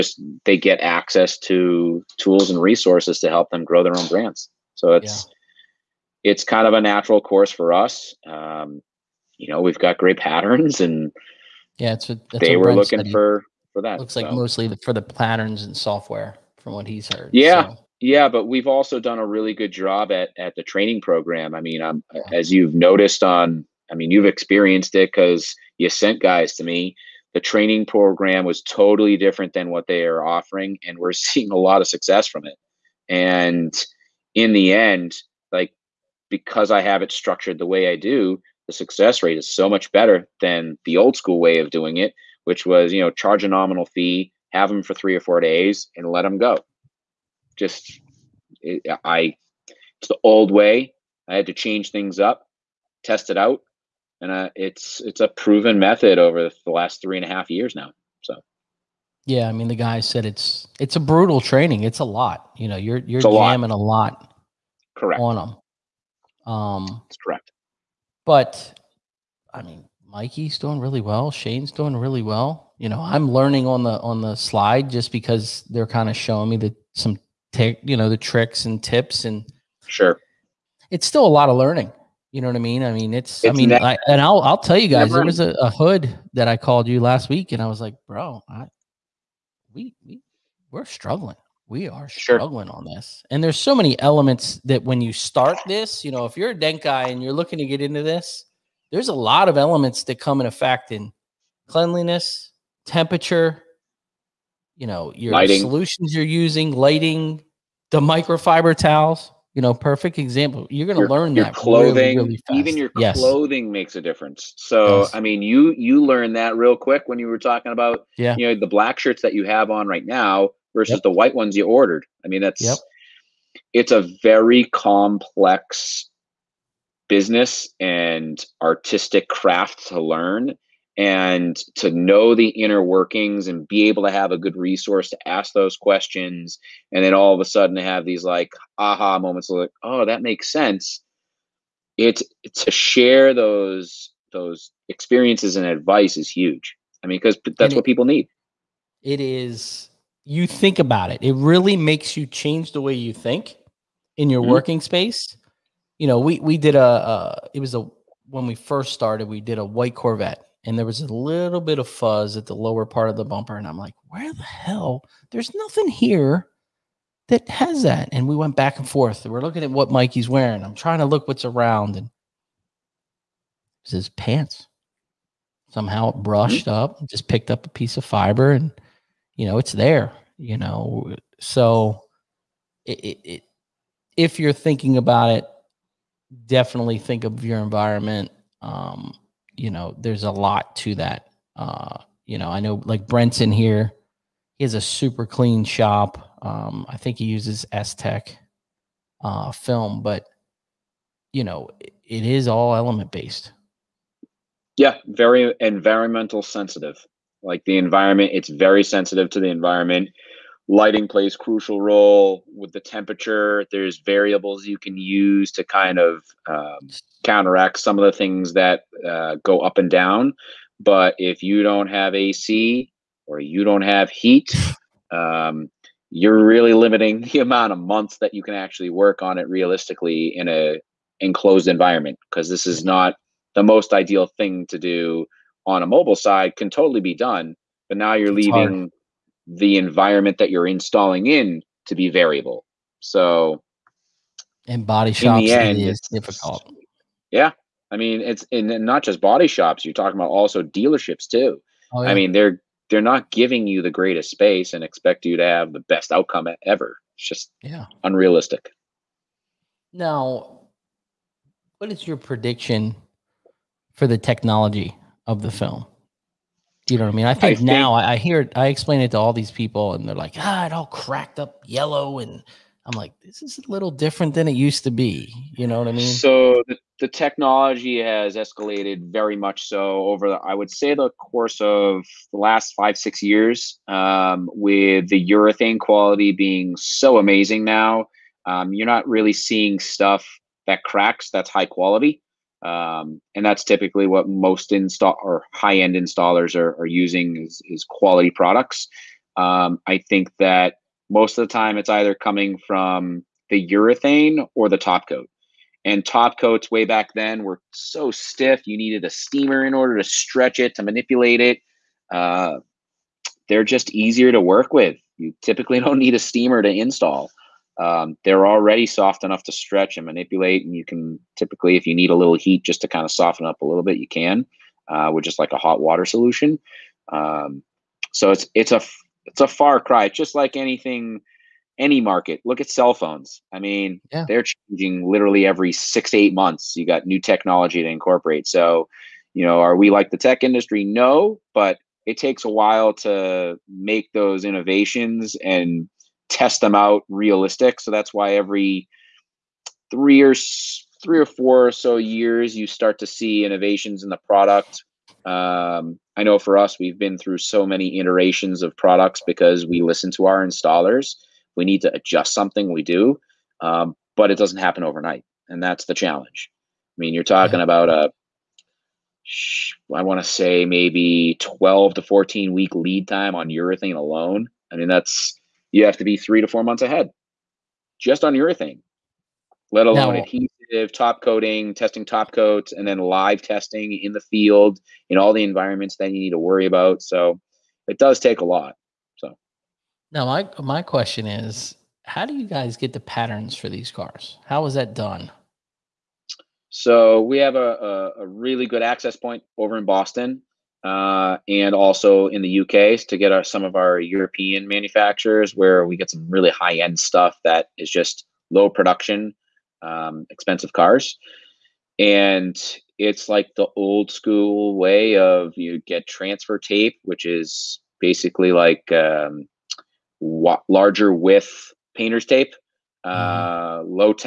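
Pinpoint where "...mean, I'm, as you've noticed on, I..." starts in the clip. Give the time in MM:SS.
00:21.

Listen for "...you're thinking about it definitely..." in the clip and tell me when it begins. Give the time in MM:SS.
03:04.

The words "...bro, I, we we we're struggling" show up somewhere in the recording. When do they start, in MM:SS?
01:28.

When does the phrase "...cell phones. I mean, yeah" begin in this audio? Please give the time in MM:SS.
05:32.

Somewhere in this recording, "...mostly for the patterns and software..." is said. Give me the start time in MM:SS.
00:14.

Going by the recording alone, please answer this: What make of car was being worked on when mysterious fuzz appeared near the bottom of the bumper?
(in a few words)
Corvette.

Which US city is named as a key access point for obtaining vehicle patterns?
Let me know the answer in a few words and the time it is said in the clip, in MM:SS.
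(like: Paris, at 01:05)
Boston, at 06:39.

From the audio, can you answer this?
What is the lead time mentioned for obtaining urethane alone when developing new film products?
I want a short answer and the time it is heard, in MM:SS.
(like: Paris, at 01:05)
12 to 14 weeks, at 06:11.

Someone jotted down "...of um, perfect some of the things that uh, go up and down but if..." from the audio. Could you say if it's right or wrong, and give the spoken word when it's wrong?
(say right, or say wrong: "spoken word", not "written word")
wrong: "counteract", not "perfect".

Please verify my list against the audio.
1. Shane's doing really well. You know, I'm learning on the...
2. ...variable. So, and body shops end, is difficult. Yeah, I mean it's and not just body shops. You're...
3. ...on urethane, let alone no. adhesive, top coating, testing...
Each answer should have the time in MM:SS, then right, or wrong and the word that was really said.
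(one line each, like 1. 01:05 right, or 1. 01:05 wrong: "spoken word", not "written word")
1. 01:11 right
2. 04:02 right
3. 06:18 right.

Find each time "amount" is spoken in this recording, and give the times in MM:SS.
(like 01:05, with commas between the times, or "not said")
03:47.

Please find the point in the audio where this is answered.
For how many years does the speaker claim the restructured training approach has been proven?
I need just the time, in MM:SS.
00:57.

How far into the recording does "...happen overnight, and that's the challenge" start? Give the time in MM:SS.
06:04.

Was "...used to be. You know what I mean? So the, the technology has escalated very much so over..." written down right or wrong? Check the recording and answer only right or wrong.
right.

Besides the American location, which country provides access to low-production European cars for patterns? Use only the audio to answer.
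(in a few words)
UK.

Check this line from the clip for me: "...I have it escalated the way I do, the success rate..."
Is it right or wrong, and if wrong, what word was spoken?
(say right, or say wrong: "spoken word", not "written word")
wrong: "structured", not "escalated".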